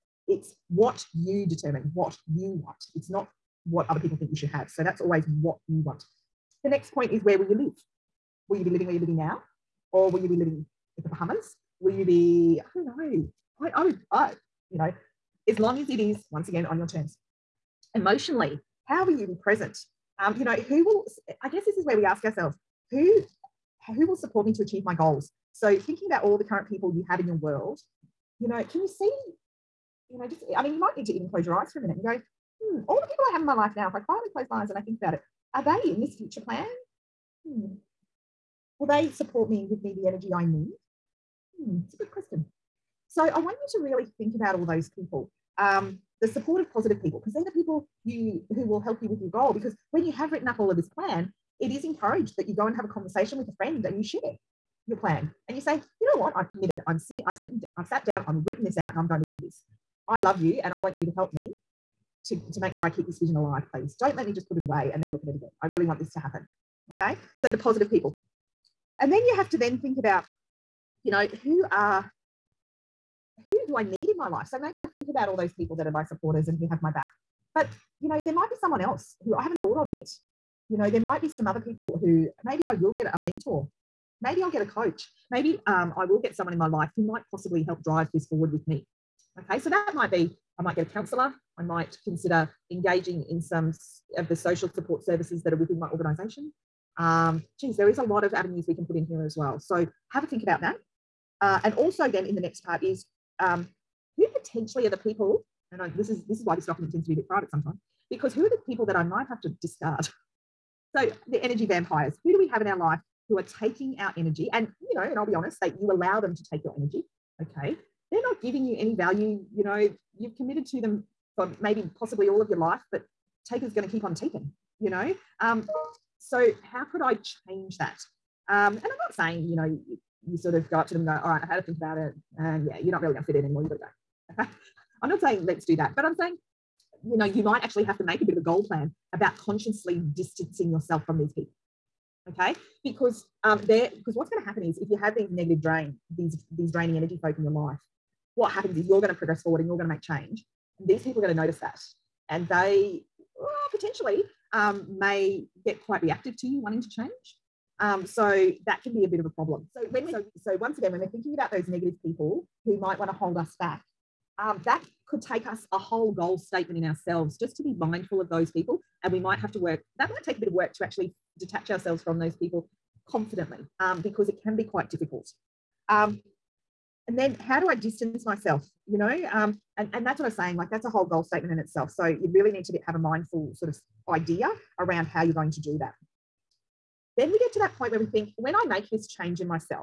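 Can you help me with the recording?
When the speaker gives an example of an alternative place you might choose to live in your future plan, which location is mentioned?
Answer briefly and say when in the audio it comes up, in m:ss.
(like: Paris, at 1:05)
The Bahamas, at 0:11.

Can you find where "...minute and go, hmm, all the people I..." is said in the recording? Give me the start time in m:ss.
0:31.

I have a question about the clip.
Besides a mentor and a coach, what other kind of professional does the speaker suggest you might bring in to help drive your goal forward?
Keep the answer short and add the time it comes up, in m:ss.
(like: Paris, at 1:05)
A counselor, at 1:30.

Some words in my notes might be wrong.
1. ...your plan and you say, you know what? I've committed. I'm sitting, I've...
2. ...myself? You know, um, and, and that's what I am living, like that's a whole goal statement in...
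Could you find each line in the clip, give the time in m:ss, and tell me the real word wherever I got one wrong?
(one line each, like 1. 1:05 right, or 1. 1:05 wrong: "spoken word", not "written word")
1. 0:54 right
2. 2:58 wrong: "saying", not "living".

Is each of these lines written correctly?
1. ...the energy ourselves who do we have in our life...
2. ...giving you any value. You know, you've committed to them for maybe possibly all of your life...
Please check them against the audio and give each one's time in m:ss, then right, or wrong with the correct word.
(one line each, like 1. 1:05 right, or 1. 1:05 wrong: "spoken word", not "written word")
1. 1:51 wrong: "vampires", not "ourselves"
2. 1:58 right.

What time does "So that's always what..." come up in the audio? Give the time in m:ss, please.
0:04.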